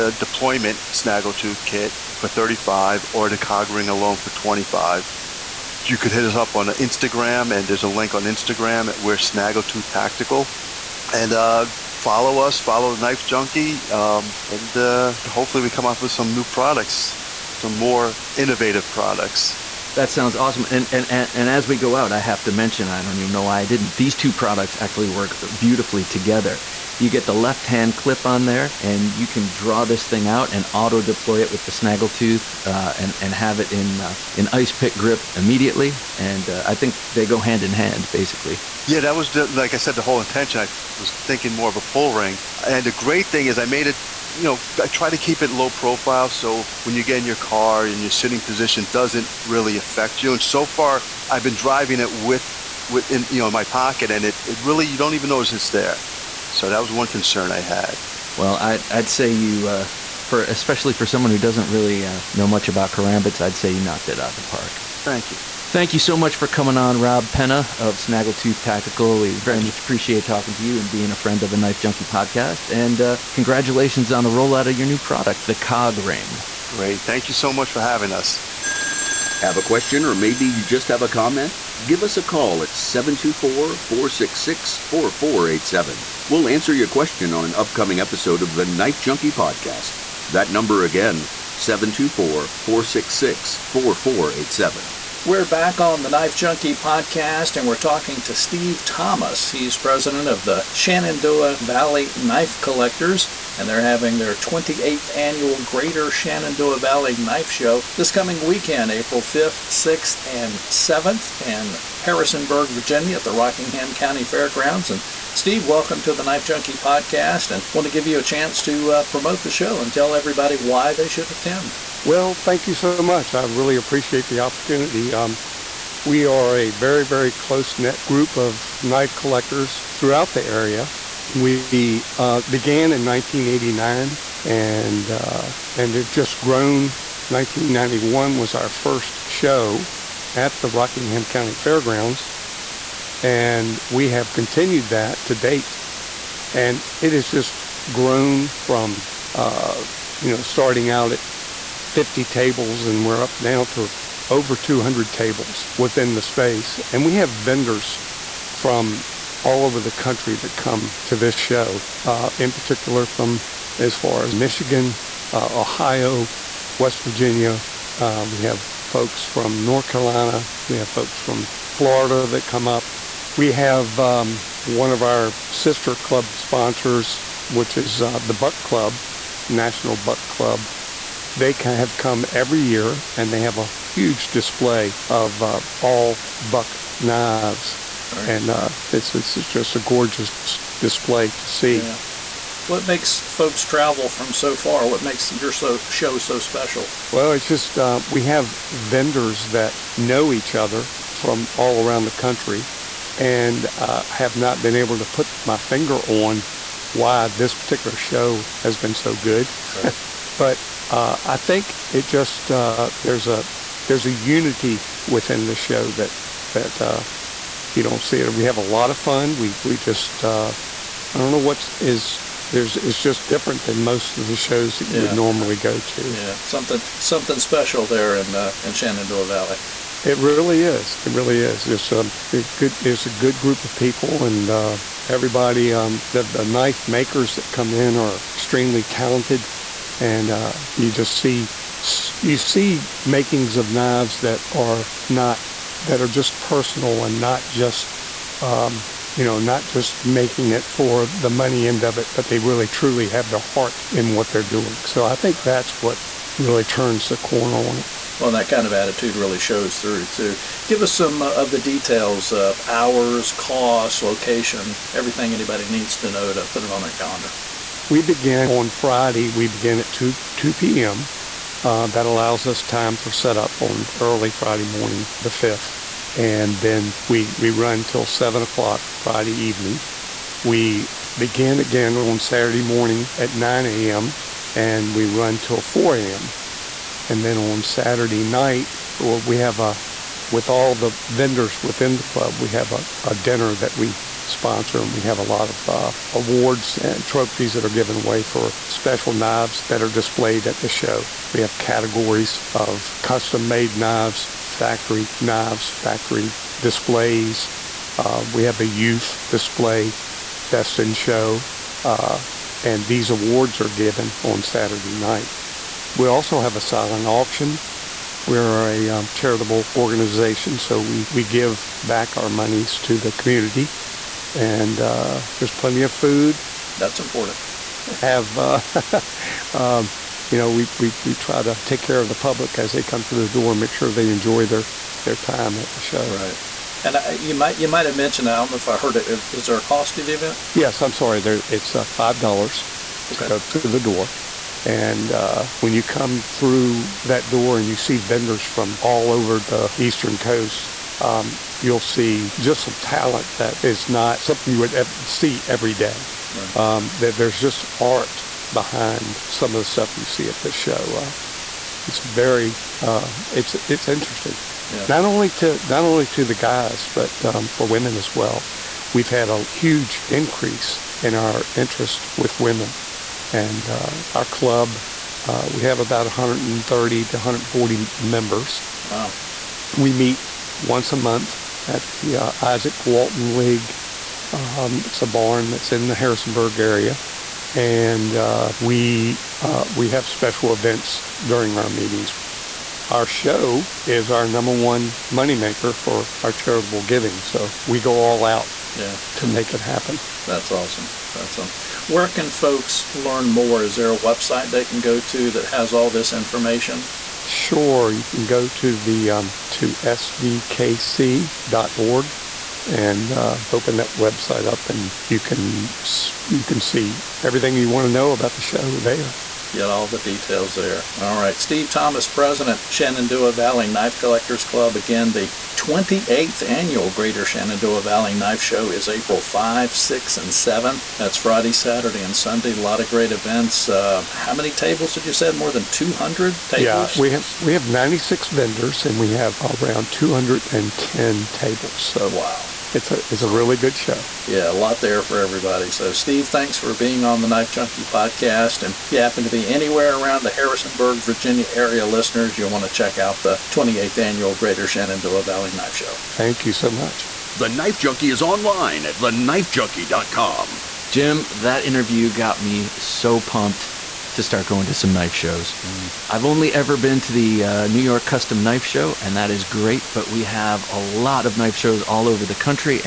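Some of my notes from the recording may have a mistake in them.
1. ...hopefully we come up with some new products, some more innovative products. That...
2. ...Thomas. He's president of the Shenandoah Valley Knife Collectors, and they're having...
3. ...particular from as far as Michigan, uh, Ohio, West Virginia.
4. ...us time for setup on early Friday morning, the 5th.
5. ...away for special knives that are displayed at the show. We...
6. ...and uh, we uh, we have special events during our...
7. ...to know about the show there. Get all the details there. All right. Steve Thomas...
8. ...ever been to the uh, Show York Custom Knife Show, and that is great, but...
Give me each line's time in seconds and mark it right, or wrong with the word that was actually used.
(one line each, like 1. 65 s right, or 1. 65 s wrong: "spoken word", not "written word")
1. 15 s right
2. 98 s right
3. 162 s right
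4. 272 s right
5. 297 s right
6. 387 s right
7. 417 s right
8. 466 s wrong: "New", not "Show".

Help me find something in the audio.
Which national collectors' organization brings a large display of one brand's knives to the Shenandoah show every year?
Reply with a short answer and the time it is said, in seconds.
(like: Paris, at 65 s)
National Buck Club, at 179 s.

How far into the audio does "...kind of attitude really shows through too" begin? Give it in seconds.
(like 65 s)
258 s.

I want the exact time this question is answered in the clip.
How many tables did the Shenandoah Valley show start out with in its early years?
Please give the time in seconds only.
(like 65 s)
151 s.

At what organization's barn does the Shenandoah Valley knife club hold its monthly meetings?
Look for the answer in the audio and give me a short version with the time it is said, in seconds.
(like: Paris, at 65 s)
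Izaak Walton League, at 382 s.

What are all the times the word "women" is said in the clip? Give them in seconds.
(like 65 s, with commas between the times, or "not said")
367 s, 372 s.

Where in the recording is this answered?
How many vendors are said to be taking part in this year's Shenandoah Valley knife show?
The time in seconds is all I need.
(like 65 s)
437 s.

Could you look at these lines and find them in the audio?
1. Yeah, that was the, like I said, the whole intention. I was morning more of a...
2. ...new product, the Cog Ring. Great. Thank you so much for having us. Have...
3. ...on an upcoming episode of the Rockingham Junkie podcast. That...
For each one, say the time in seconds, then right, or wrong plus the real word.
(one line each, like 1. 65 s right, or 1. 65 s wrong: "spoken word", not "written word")
1. 38 s wrong: "thinking", not "morning"
2. 74 s right
3. 87 s wrong: "Knife", not "Rockingham".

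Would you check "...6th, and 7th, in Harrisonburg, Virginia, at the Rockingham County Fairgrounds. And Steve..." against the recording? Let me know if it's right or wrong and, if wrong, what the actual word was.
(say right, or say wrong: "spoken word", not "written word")
right.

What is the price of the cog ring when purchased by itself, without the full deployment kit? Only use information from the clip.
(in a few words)
$25.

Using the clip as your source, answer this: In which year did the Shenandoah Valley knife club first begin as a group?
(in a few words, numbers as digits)
1989.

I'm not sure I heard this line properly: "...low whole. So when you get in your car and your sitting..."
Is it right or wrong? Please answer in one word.
wrong.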